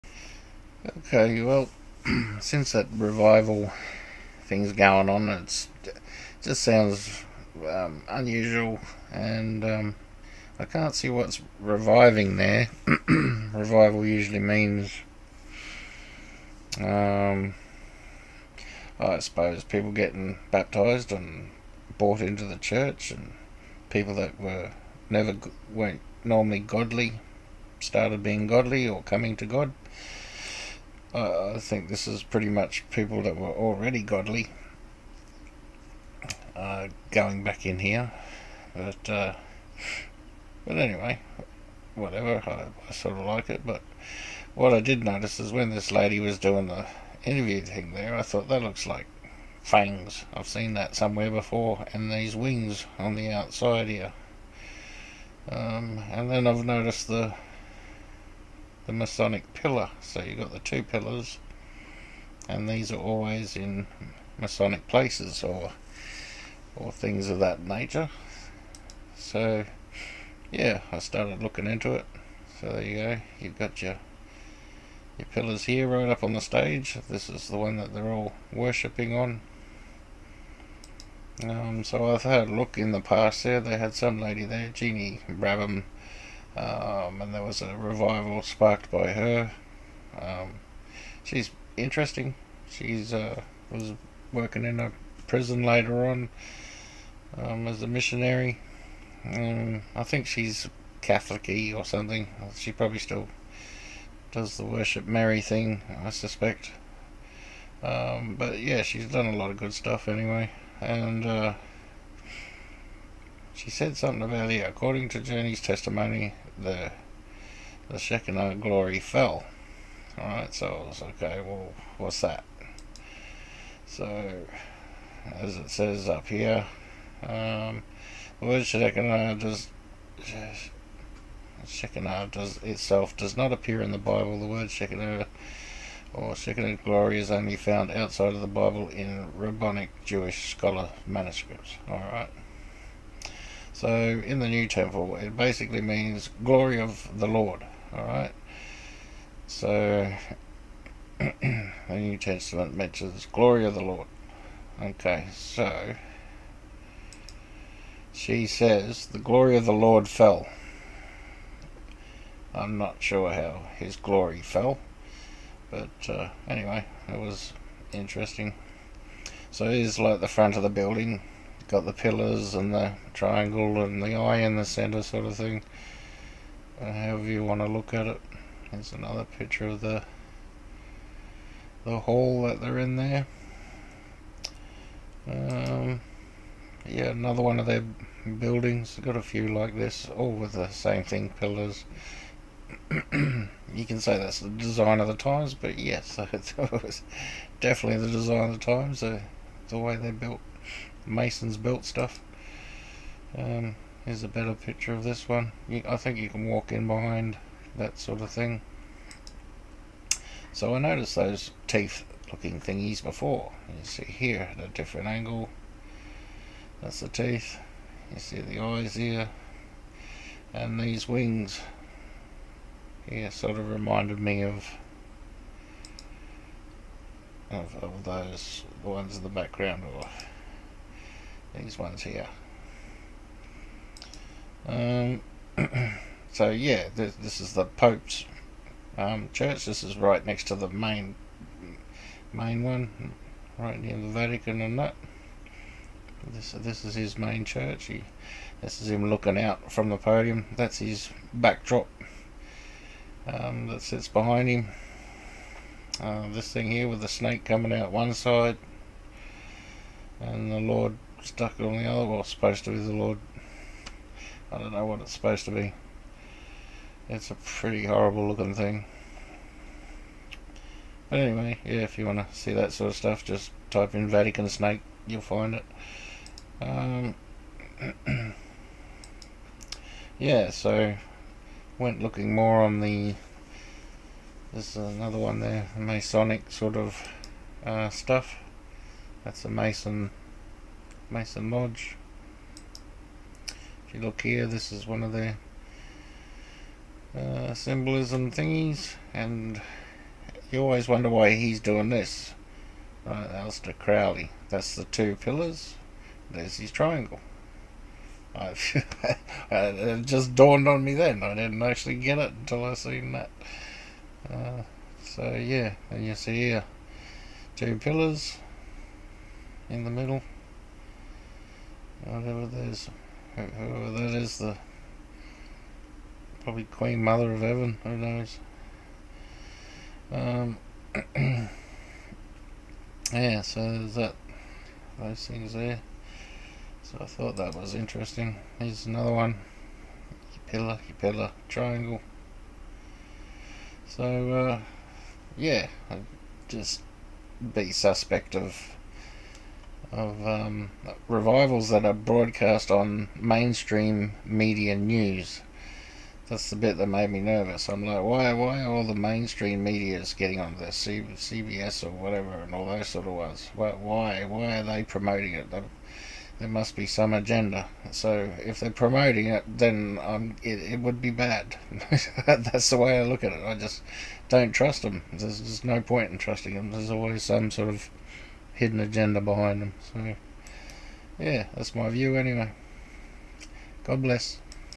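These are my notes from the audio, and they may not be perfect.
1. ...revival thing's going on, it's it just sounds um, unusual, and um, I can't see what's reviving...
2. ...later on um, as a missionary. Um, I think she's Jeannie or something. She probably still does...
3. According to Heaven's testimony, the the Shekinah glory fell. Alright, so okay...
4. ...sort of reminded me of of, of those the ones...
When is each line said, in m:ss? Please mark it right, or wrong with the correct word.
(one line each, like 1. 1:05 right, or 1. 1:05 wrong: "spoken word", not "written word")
1. 0:02 right
2. 1:35 wrong: "Catholicy", not "Jeannie"
3. 1:54 wrong: "Journey", not "Heaven"
4. 3:43 right.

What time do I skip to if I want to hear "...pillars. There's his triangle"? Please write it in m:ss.
5:05.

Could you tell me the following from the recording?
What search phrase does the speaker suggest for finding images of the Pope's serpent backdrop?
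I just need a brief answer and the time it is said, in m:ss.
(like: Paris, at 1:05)
Vatican Snake, at 4:34.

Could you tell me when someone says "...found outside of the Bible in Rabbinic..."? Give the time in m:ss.
2:17.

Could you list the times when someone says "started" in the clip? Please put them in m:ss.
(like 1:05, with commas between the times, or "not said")
0:27, 1:10.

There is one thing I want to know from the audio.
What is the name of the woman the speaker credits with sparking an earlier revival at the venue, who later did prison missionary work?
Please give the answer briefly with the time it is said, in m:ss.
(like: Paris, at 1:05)
Jeannie Brabham, at 1:24.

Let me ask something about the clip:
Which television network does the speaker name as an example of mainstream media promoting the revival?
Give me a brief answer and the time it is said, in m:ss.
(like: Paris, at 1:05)
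CBS, at 6:00.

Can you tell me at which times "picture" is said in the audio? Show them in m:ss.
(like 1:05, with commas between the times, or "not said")
2:59, 3:24.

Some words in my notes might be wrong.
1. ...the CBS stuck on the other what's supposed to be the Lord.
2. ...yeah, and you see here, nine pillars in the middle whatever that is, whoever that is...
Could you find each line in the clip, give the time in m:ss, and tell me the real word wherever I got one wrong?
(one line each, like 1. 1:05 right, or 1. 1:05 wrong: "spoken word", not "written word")
1. 4:20 wrong: "Lord", not "CBS"
2. 5:15 wrong: "two", not "nine".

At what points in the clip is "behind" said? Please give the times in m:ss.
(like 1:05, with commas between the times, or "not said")
3:26, 4:14, 6:19.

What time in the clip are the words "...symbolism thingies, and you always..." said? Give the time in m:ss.
4:57.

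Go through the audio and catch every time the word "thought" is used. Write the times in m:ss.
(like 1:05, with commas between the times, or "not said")
0:48, 5:37.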